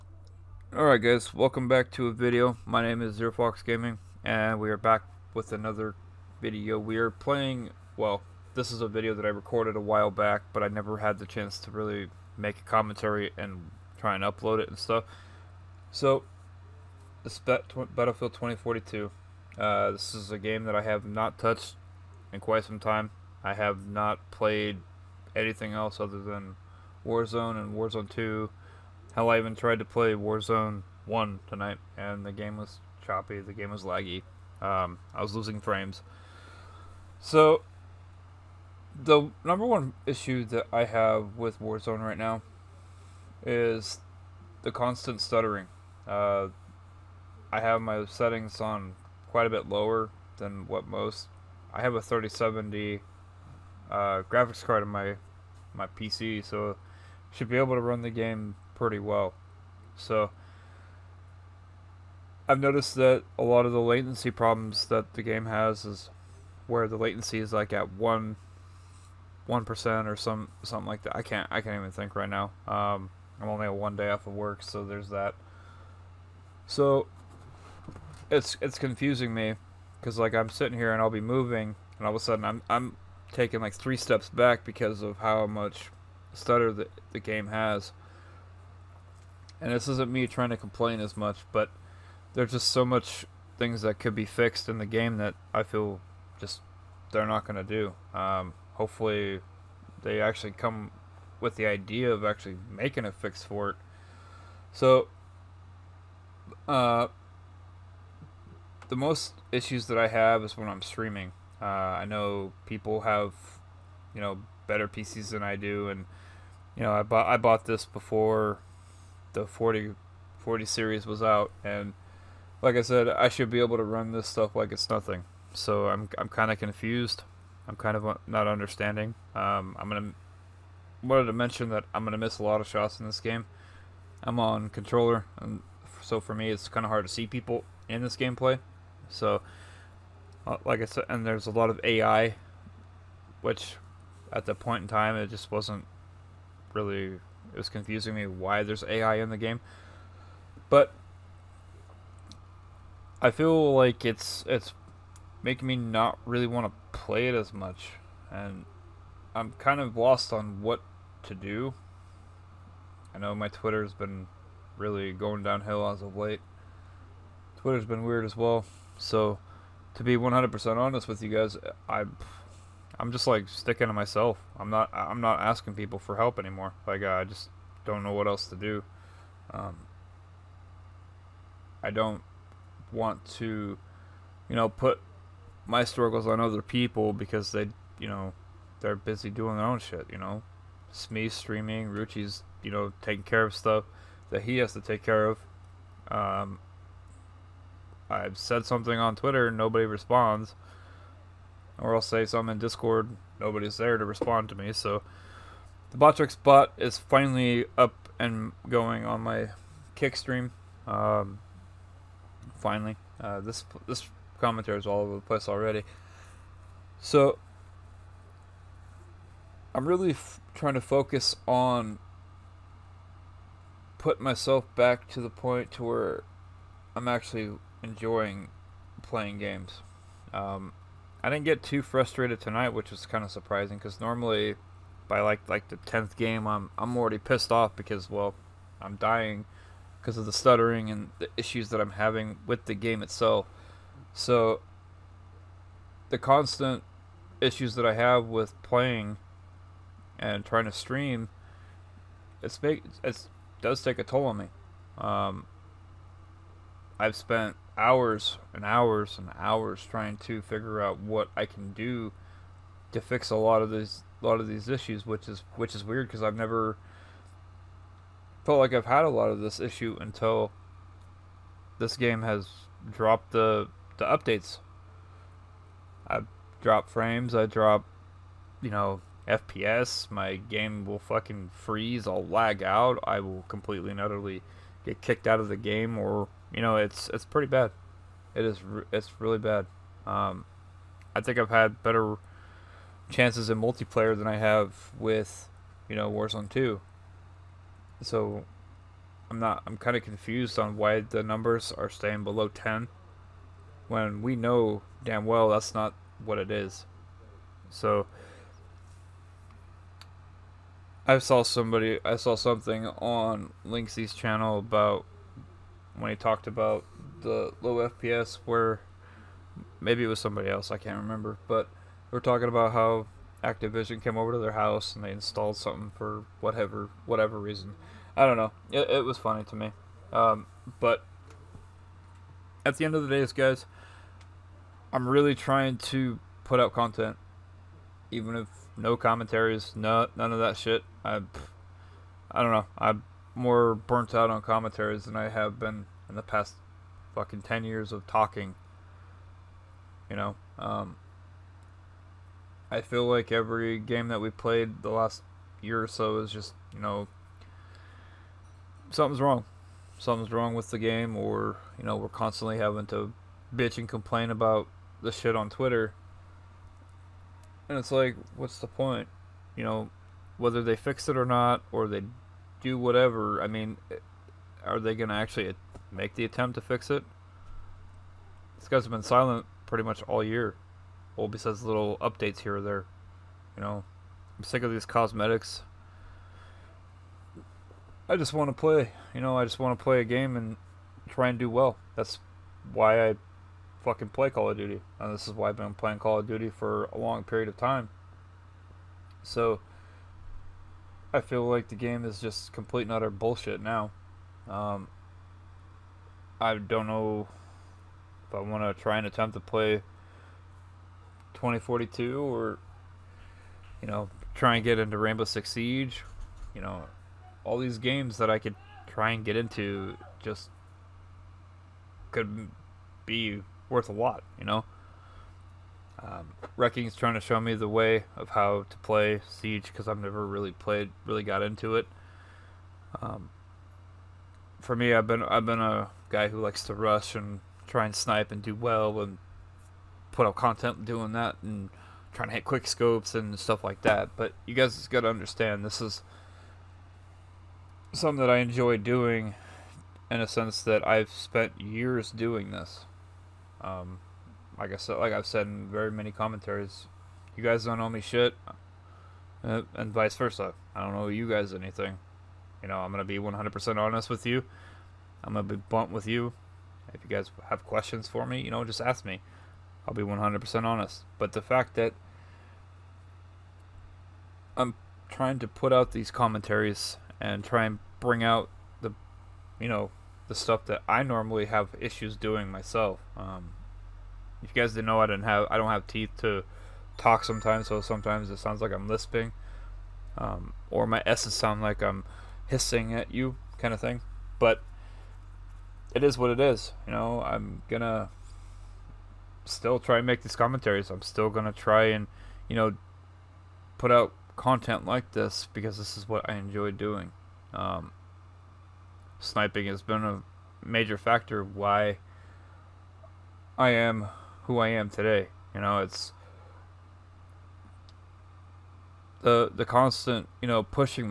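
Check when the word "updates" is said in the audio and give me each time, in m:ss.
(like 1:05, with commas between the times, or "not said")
4:34, 6:22.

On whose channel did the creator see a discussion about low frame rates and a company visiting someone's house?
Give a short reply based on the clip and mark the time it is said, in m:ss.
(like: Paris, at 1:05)
Linksy, at 5:13.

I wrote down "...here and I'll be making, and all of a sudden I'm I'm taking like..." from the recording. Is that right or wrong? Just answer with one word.
wrong.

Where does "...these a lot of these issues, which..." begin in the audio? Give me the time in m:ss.
4:23.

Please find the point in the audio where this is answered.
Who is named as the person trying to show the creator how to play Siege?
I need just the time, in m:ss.
7:06.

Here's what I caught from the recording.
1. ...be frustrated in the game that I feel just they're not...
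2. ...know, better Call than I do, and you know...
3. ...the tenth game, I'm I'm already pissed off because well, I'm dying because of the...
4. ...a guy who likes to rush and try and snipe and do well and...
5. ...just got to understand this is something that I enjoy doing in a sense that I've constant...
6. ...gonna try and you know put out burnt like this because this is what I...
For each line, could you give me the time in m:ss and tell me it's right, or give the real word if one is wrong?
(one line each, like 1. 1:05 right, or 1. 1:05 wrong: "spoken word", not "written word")
1. 1:34 wrong: "fixed", not "frustrated"
2. 1:54 wrong: "PCs", not "Call"
3. 3:55 right
4. 7:15 right
5. 7:24 wrong: "spent", not "constant"
6. 8:21 wrong: "content", not "burnt".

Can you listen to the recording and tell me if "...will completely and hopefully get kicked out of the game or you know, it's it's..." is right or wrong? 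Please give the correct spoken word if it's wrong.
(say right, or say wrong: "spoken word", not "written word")
wrong: "utterly", not "hopefully".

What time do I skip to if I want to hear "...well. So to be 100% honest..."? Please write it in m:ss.
2:48.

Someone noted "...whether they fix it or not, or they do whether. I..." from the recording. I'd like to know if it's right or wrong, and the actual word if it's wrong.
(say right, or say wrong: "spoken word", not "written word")
wrong: "whatever", not "whether".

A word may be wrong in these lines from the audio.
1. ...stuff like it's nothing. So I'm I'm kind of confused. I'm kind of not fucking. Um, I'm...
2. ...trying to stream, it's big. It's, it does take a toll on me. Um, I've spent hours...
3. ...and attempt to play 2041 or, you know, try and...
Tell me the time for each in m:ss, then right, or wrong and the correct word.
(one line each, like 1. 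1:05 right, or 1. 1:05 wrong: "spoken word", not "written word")
1. 2:04 wrong: "understanding", not "fucking"
2. 4:10 right
3. 6:48 wrong: "2042", not "2041".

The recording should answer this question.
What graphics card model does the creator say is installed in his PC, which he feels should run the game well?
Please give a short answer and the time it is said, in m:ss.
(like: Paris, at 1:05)
3070, at 0:52.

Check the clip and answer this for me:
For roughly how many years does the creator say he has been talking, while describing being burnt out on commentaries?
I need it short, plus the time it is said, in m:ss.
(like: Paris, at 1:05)
10, at 5:47.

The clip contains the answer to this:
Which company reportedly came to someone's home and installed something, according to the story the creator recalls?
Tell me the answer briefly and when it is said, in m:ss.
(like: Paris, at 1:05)
Activision, at 5:23.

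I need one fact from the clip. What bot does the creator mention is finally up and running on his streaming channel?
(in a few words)
Botrix.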